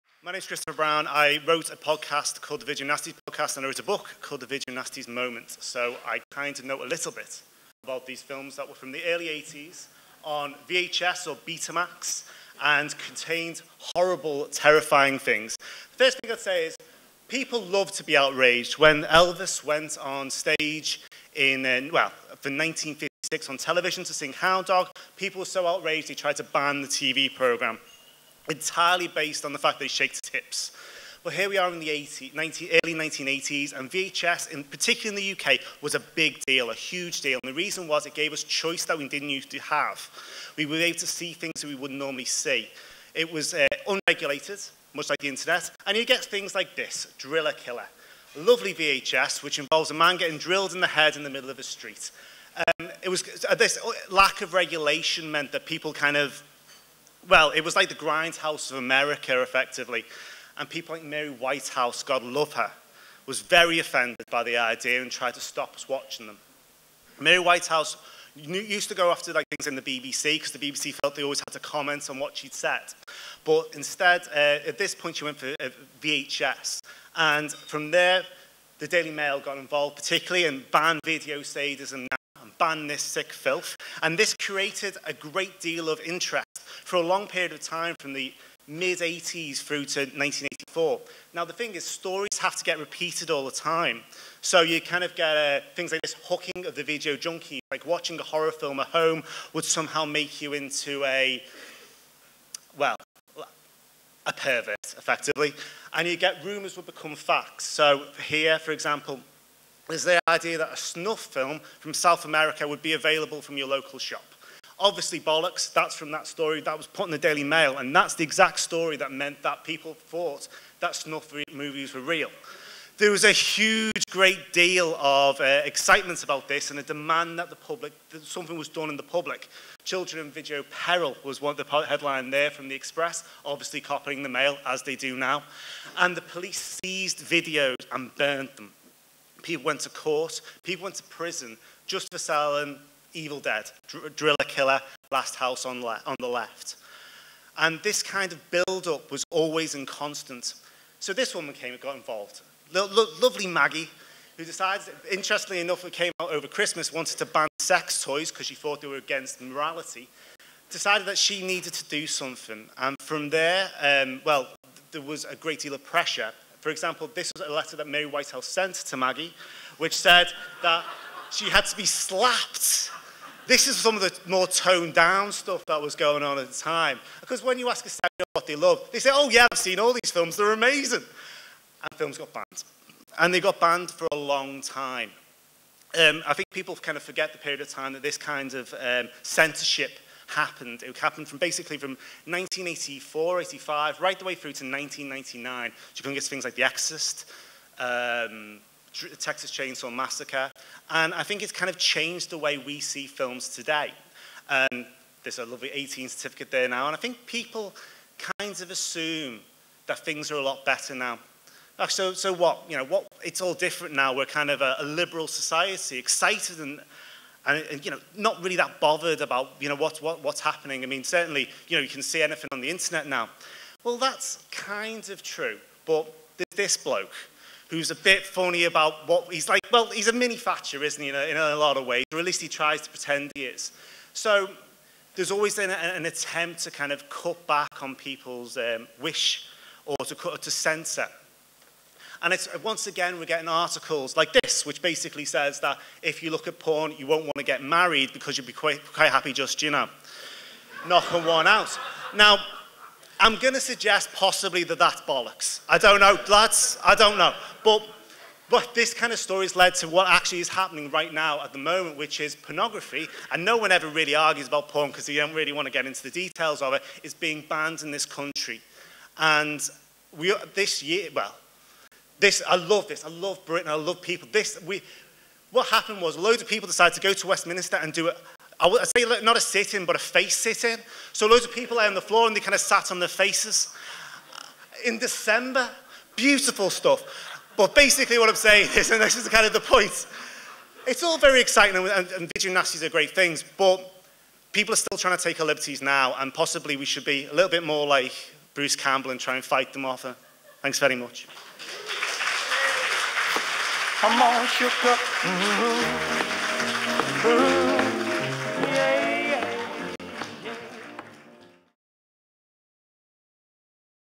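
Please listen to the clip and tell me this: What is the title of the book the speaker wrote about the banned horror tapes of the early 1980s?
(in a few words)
The Video Nasties Moment.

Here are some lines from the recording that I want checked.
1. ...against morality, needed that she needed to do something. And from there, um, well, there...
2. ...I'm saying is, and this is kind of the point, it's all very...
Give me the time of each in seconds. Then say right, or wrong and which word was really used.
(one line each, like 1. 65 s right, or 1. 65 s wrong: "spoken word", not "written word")
1. 158 s wrong: "decided", not "needed"
2. 288 s right.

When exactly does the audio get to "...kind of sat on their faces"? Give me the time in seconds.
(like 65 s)
282 s.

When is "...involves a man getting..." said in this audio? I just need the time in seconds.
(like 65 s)
49 s.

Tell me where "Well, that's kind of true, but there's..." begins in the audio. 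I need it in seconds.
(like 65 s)
223 s.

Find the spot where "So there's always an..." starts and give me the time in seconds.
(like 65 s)
234 s.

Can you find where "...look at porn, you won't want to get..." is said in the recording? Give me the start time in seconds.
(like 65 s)
246 s.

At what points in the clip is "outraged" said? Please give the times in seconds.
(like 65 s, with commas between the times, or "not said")
18 s, 25 s.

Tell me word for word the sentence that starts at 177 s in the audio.
Because when you ask a stand what they love, they say, oh yeah, I've seen all these films, they're amazing.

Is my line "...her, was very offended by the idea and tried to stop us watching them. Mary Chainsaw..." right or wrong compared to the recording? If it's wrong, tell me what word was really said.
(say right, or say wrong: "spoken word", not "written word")
wrong: "Whitehouse", not "Chainsaw".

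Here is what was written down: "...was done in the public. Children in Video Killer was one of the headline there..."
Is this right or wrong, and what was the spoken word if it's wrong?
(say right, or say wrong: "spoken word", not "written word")
wrong: "Peril", not "Killer".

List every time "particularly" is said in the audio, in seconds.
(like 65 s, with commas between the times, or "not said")
34 s, 79 s.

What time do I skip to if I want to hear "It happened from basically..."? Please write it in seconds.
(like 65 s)
190 s.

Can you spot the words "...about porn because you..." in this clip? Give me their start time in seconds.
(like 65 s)
264 s.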